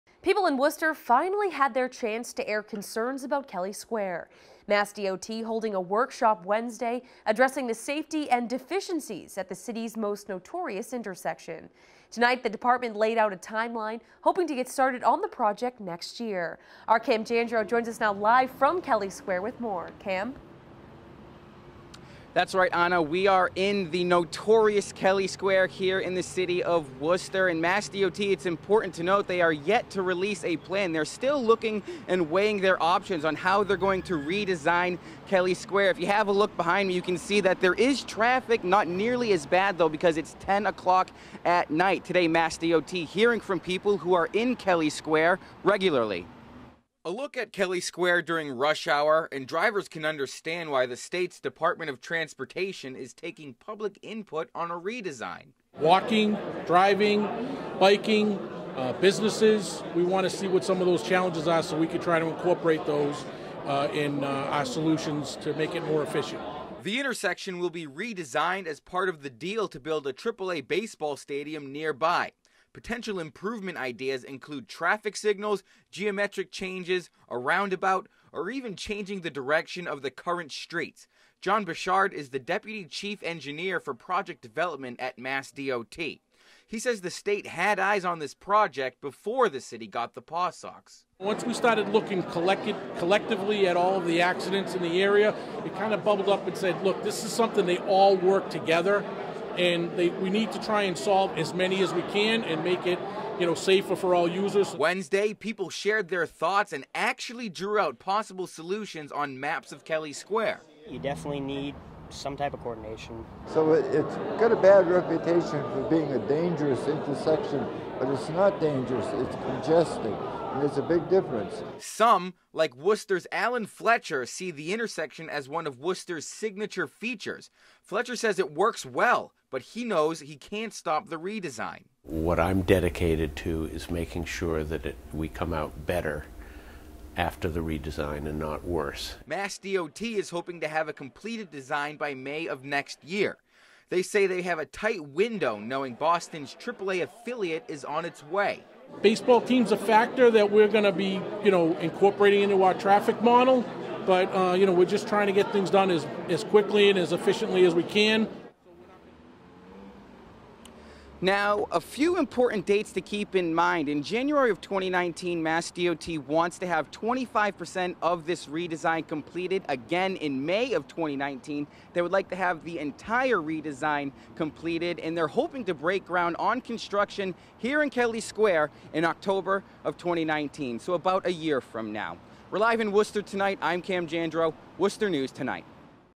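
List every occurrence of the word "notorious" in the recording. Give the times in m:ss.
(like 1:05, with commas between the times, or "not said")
0:10, 0:24.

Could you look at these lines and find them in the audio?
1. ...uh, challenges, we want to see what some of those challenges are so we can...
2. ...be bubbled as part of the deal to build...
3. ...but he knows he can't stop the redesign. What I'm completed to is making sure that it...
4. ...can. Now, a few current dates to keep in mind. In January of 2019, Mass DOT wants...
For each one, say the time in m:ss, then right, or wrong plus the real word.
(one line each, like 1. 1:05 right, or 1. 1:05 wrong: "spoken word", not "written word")
1. 0:58 wrong: "businesses", not "challenges"
2. 1:07 wrong: "redesigned", not "bubbled"
3. 2:09 wrong: "dedicated", not "completed"
4. 2:37 wrong: "important", not "current".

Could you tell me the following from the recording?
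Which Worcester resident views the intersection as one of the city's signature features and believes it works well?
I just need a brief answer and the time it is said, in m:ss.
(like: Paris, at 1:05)
Alan Fletcher, at 2:03.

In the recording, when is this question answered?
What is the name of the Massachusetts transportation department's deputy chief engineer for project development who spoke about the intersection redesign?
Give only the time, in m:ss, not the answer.
1:21.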